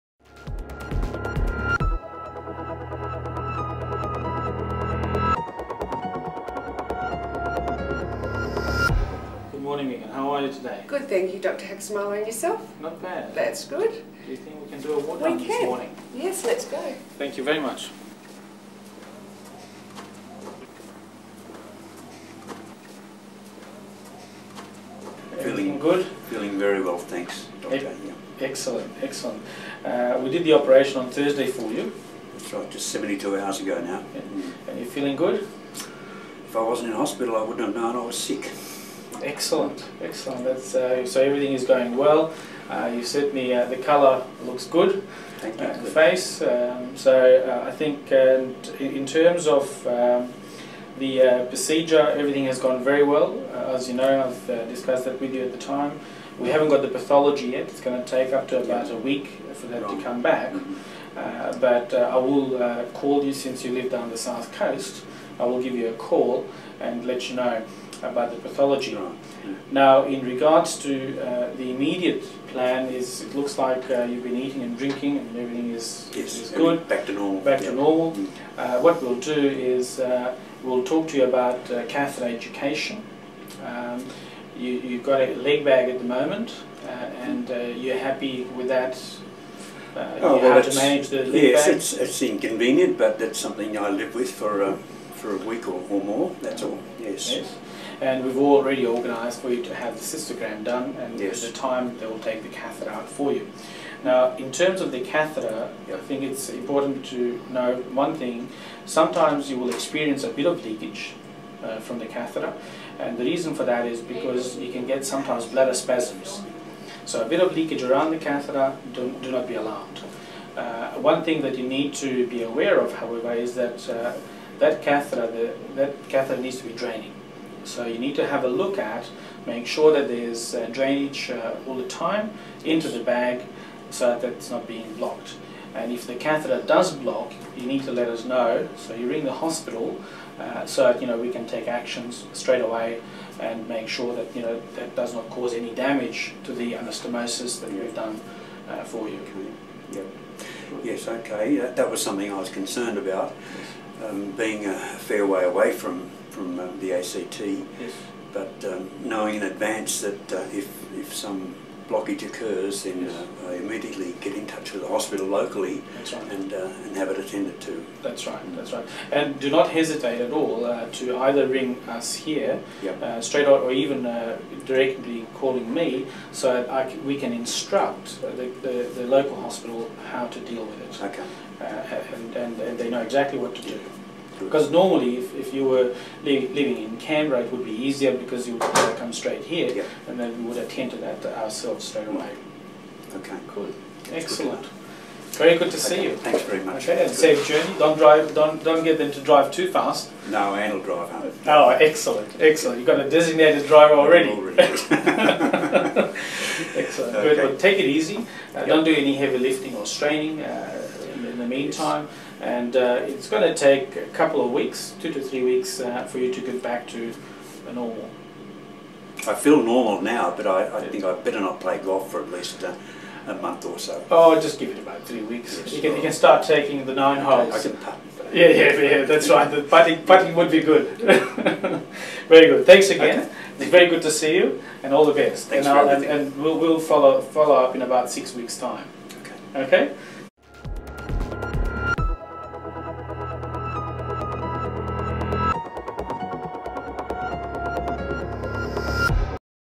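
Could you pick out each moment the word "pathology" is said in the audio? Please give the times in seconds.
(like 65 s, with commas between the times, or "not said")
56 s, 68 s.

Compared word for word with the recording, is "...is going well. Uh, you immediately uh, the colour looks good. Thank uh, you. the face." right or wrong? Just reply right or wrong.
wrong.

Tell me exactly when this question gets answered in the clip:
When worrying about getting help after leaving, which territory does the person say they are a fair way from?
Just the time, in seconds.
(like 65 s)
156 s.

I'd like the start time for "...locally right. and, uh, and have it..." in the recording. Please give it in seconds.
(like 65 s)
165 s.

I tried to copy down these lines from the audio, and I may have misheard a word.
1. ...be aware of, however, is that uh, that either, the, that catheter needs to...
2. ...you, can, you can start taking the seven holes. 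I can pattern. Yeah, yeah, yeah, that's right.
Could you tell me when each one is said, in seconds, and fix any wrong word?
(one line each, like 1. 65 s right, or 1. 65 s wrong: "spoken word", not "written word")
1. 122 s wrong: "catheter", not "either"
2. 225 s wrong: "nine", not "seven".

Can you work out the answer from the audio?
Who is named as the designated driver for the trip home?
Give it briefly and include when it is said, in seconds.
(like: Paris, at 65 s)
Anne, at 200 s.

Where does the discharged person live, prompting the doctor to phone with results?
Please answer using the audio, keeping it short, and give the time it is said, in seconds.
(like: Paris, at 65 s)
South coast, at 64 s.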